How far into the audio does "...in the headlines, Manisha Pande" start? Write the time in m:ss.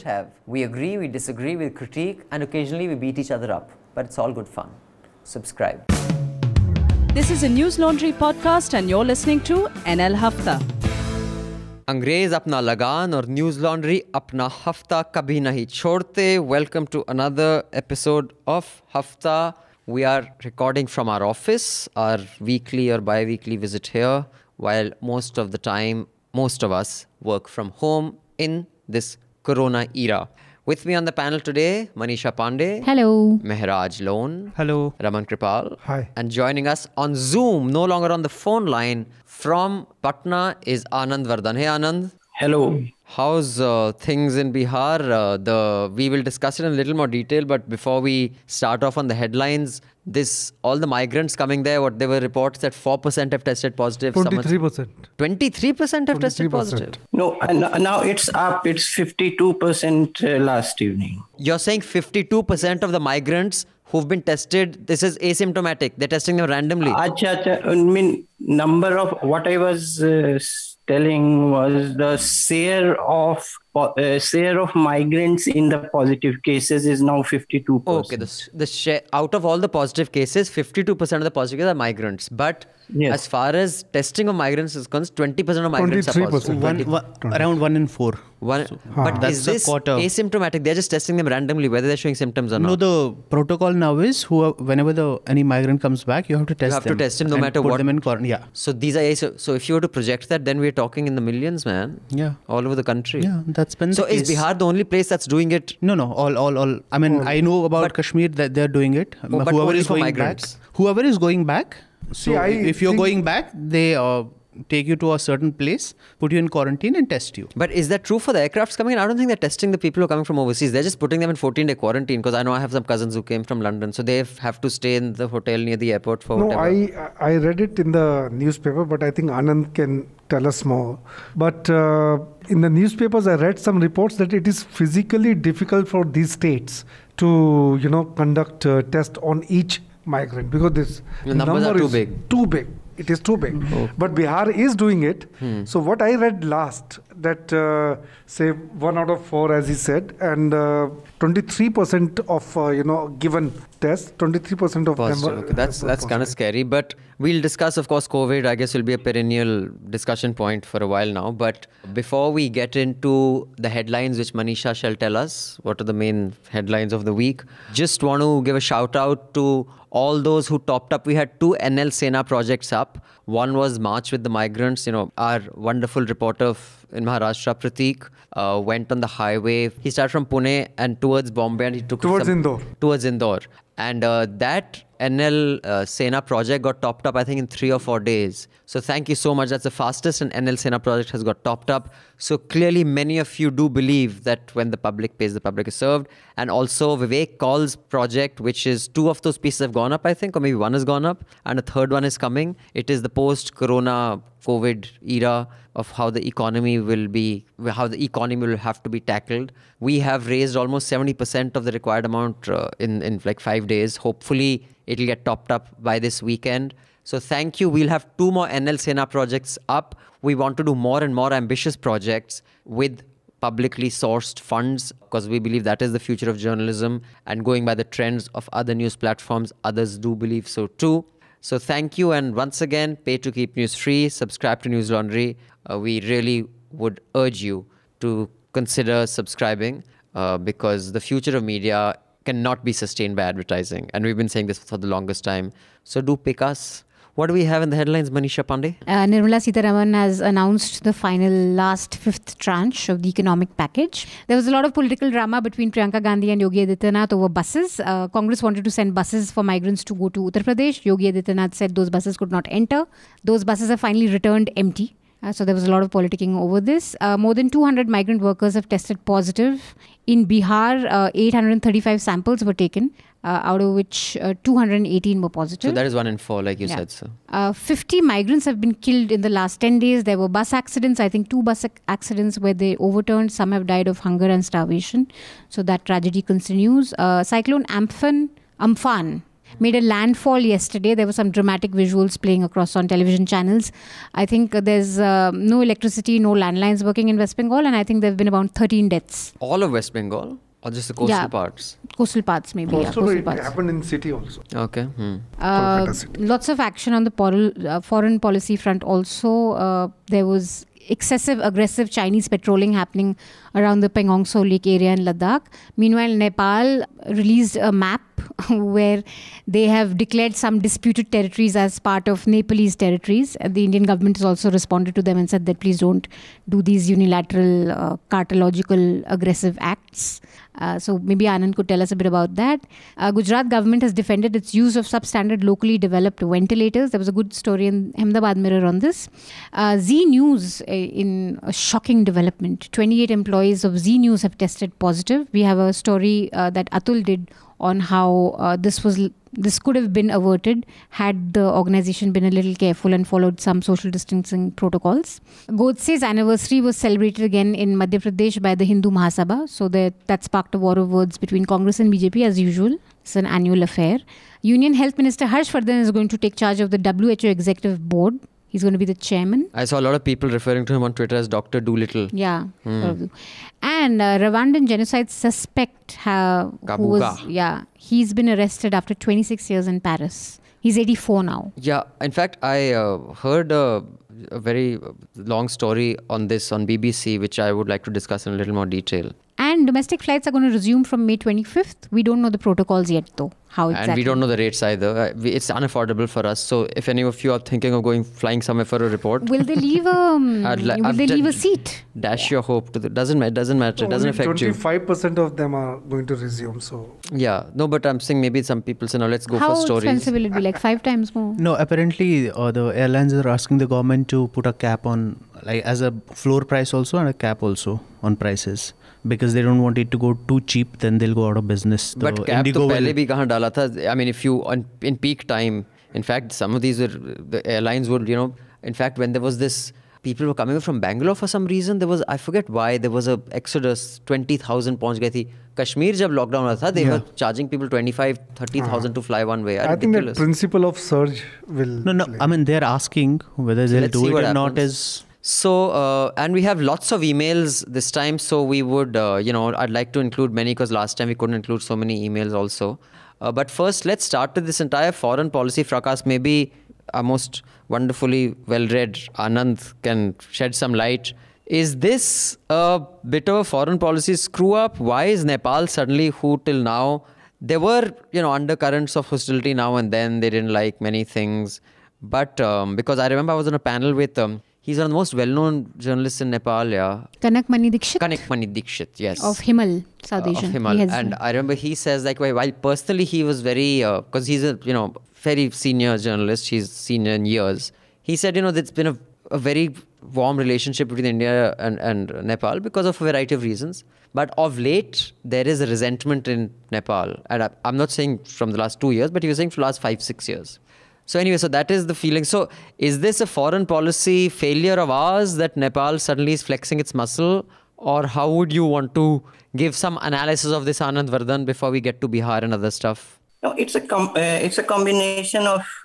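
4:07.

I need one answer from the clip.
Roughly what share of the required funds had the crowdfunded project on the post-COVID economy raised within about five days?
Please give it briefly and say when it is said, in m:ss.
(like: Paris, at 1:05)
70%, at 3:30.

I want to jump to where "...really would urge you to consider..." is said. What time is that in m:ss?
3:56.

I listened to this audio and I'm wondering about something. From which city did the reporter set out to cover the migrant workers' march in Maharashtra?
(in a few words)
Pune.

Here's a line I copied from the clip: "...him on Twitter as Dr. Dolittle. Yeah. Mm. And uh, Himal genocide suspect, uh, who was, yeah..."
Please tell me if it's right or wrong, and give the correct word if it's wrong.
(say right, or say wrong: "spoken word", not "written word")
wrong: "Rwandan", not "Himal".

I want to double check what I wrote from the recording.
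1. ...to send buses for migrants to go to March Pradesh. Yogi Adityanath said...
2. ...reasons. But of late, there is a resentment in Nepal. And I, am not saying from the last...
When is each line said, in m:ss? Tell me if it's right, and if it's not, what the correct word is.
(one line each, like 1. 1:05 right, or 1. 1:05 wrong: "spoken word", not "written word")
1. 4:18 wrong: "Uttar", not "March"
2. 8:13 right.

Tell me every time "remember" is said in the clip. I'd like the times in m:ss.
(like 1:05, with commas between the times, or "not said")
7:53, 8:01.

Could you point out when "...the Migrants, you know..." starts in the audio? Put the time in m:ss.
2:54.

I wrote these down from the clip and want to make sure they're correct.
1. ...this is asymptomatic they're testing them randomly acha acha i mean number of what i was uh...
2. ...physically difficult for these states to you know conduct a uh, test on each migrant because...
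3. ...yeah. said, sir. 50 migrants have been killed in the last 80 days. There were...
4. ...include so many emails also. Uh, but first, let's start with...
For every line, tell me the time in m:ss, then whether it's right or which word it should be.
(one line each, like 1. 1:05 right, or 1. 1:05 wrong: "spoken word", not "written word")
1. 1:04 right
2. 2:14 right
3. 4:36 wrong: "10", not "80"
4. 7:31 right.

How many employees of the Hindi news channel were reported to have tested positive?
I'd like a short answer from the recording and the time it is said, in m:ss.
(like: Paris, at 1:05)
28, at 5:42.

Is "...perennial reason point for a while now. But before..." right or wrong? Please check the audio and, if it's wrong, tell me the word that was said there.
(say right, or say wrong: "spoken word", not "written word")
wrong: "discussion", not "reason".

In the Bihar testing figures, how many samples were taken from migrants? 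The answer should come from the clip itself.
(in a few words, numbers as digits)
835.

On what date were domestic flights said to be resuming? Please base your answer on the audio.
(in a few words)
May 25th.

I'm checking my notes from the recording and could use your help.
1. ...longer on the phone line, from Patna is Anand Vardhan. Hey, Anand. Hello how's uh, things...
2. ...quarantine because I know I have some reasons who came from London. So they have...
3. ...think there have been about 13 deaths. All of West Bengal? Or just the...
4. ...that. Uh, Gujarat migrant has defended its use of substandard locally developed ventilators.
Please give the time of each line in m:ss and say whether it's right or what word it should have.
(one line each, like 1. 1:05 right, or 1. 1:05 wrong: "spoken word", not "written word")
1. 0:37 right
2. 2:01 wrong: "cousins", not "reasons"
3. 4:57 right
4. 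5:32 wrong: "government", not "migrant".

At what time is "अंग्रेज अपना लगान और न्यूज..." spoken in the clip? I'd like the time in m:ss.
0:11.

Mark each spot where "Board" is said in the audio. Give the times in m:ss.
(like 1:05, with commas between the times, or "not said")
6:07.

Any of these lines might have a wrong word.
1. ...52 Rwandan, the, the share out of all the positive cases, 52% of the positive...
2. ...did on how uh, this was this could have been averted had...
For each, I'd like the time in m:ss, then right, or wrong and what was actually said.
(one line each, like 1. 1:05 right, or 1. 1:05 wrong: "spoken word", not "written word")
1. 1:17 wrong: "Okay", not "Rwandan"
2. 5:47 right.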